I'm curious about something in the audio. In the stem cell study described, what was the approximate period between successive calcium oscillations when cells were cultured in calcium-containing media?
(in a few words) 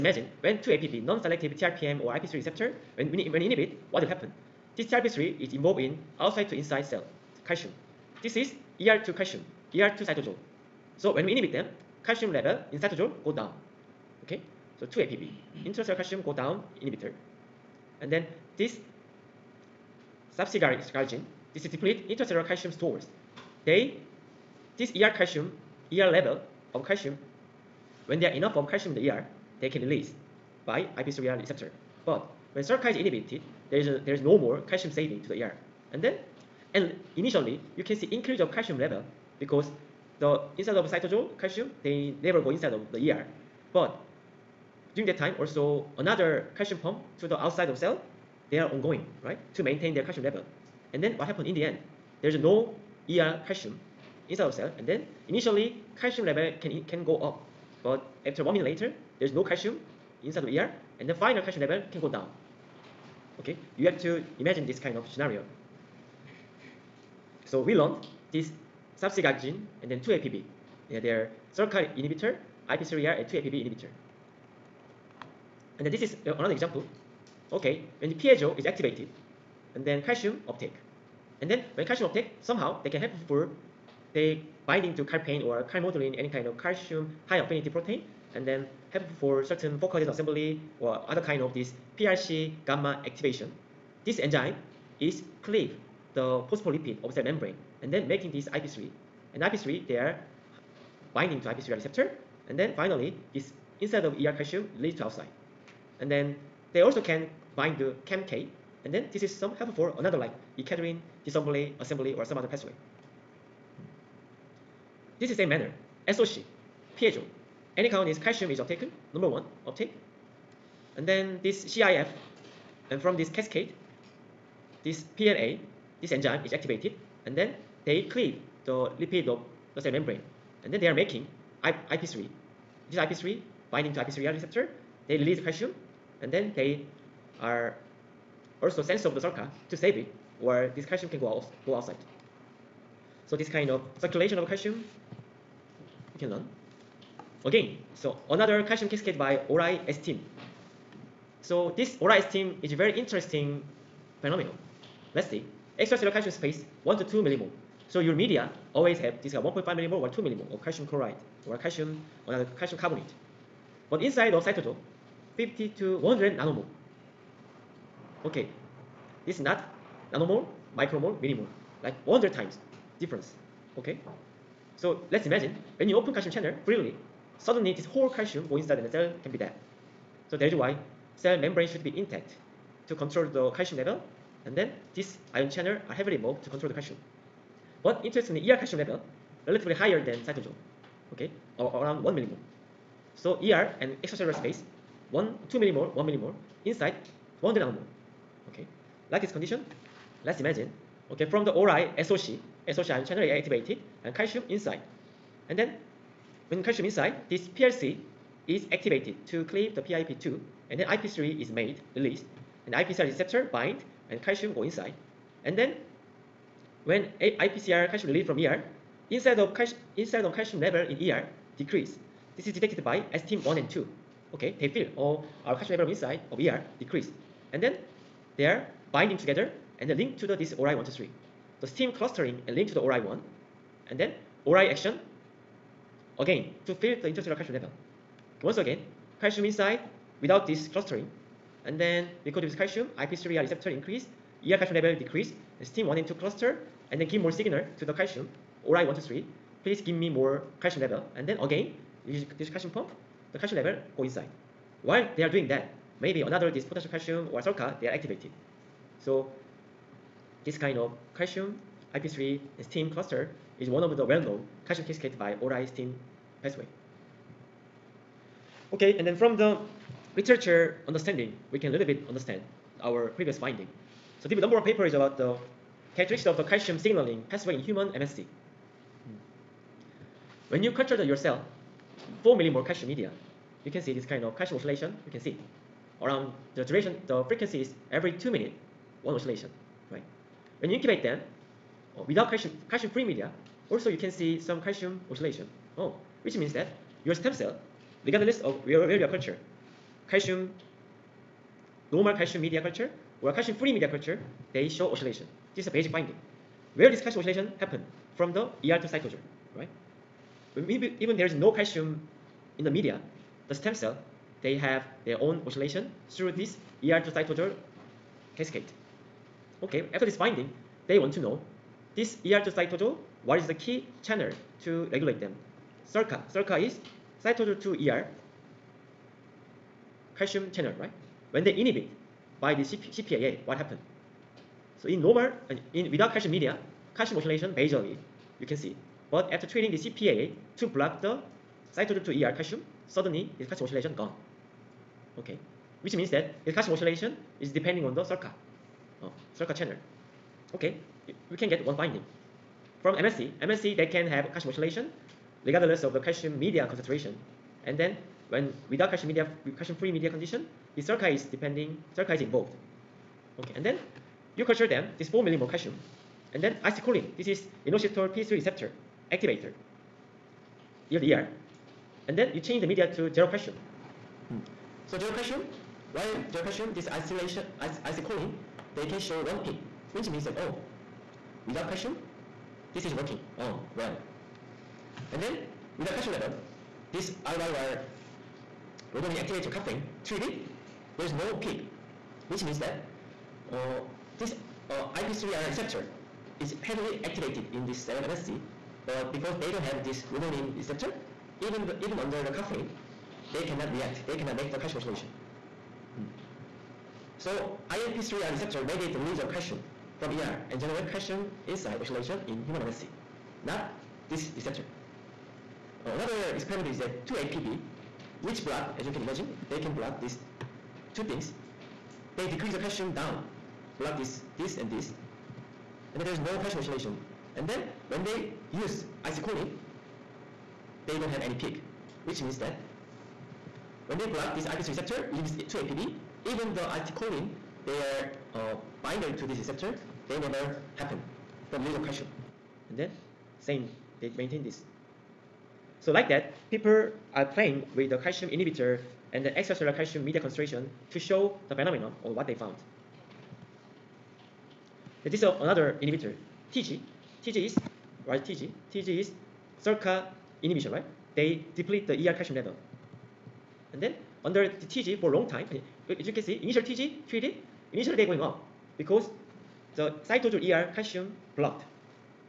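every 2 minutes.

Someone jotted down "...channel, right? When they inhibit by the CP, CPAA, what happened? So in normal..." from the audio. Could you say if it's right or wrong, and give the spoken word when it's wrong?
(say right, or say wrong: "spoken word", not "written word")
right.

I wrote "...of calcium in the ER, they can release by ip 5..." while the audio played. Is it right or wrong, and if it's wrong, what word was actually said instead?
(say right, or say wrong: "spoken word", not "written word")
wrong: "3", not "5".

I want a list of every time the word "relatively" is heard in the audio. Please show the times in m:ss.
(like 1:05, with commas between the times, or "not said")
3:09.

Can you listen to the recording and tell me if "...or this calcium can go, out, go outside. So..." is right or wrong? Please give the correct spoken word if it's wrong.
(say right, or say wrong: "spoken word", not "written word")
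right.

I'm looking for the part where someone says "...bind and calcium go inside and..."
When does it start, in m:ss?
3:33.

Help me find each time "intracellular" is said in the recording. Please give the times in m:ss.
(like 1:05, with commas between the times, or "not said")
0:15, 0:22.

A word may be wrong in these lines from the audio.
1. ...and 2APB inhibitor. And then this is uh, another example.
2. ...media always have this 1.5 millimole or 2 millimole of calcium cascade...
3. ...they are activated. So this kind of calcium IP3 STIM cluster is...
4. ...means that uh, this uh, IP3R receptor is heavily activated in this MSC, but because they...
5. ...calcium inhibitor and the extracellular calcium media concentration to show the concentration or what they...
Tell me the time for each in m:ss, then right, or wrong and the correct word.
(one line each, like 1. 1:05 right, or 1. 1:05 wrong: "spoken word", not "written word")
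1. 1:13 right
2. 2:38 wrong: "chloride", not "cascade"
3. 4:17 right
4. 6:32 right
5. 7:27 wrong: "phenomenon", not "concentration".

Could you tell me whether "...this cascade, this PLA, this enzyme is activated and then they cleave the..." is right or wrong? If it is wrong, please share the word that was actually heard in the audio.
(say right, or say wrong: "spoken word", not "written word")
right.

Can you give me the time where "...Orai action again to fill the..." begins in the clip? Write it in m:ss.
3:54.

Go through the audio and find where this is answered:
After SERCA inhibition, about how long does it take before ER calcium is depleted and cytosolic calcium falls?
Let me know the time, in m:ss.
0:58.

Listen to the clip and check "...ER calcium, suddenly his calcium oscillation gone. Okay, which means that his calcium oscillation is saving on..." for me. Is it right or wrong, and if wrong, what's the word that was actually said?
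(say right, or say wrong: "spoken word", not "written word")
wrong: "depending", not "saving".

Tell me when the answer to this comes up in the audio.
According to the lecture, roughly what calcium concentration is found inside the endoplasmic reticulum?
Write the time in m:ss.
3:11.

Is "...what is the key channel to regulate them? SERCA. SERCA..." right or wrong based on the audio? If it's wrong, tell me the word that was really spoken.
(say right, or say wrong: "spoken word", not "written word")
right.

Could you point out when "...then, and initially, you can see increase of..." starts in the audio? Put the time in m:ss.
0:36.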